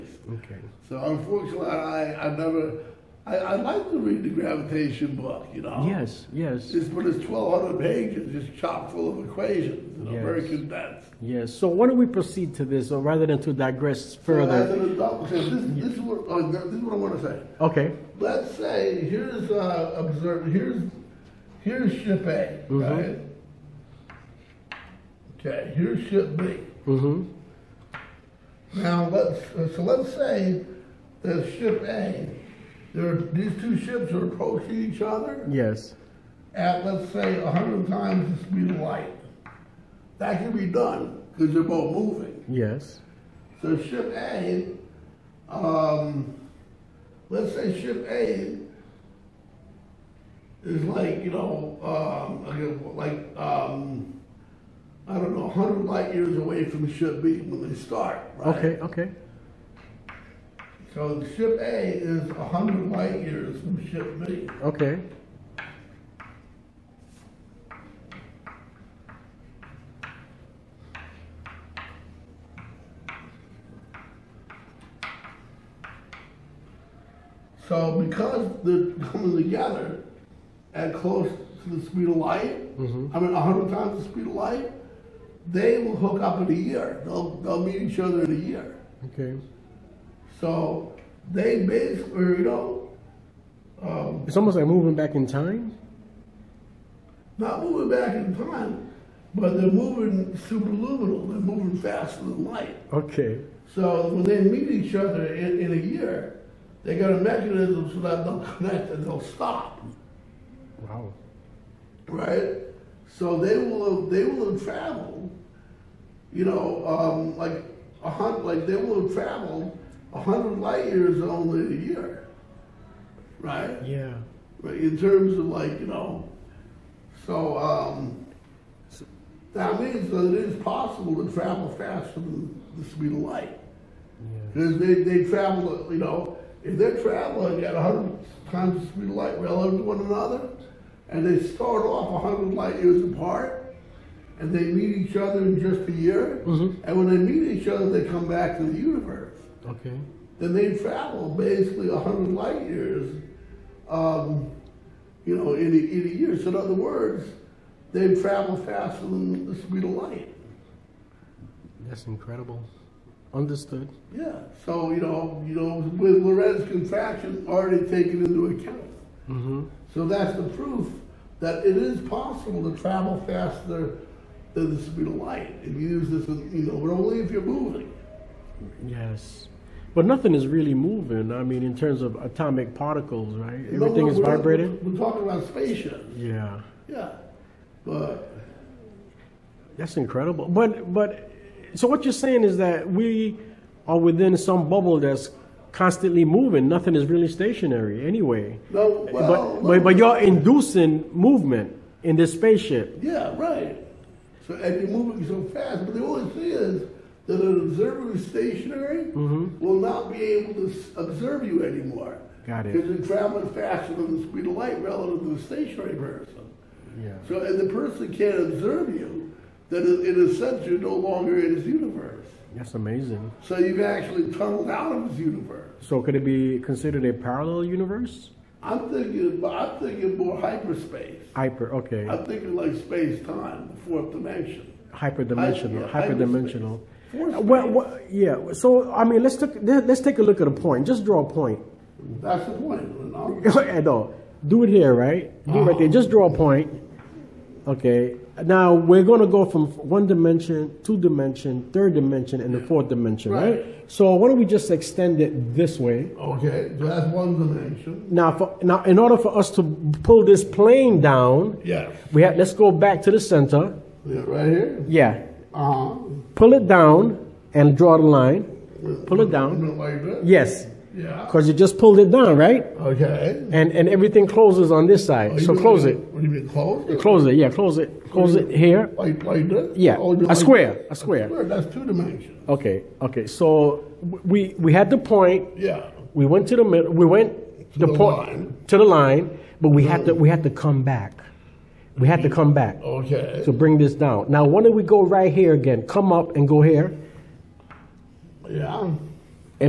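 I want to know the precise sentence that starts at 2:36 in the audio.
So in other words, they travel faster than the speed of light.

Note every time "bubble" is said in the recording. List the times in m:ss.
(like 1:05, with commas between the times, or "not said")
3:14.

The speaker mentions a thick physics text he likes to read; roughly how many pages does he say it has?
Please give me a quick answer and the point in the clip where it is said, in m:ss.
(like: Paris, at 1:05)
1,200, at 0:07.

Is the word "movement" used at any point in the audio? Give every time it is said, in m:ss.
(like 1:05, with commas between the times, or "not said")
3:21.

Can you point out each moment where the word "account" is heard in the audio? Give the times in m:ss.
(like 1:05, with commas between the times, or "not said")
2:48.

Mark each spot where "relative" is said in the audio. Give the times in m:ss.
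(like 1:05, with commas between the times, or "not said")
2:19, 3:34.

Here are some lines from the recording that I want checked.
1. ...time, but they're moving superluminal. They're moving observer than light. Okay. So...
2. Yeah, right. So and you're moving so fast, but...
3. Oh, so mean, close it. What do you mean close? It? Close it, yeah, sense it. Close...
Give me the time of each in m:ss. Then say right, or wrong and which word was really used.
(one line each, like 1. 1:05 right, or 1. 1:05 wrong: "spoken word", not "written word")
1. 1:38 wrong: "faster", not "observer"
2. 3:23 right
3. 4:35 wrong: "close", not "sense".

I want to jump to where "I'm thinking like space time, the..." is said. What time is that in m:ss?
3:52.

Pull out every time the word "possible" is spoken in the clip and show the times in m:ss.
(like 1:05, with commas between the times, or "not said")
2:10, 2:52.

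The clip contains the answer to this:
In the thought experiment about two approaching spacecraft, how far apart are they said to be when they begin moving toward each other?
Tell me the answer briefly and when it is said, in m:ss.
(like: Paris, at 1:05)
100 light years, at 0:55.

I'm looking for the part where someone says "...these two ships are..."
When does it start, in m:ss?
0:33.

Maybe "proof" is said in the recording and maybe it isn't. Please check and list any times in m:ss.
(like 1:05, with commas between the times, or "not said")
2:50.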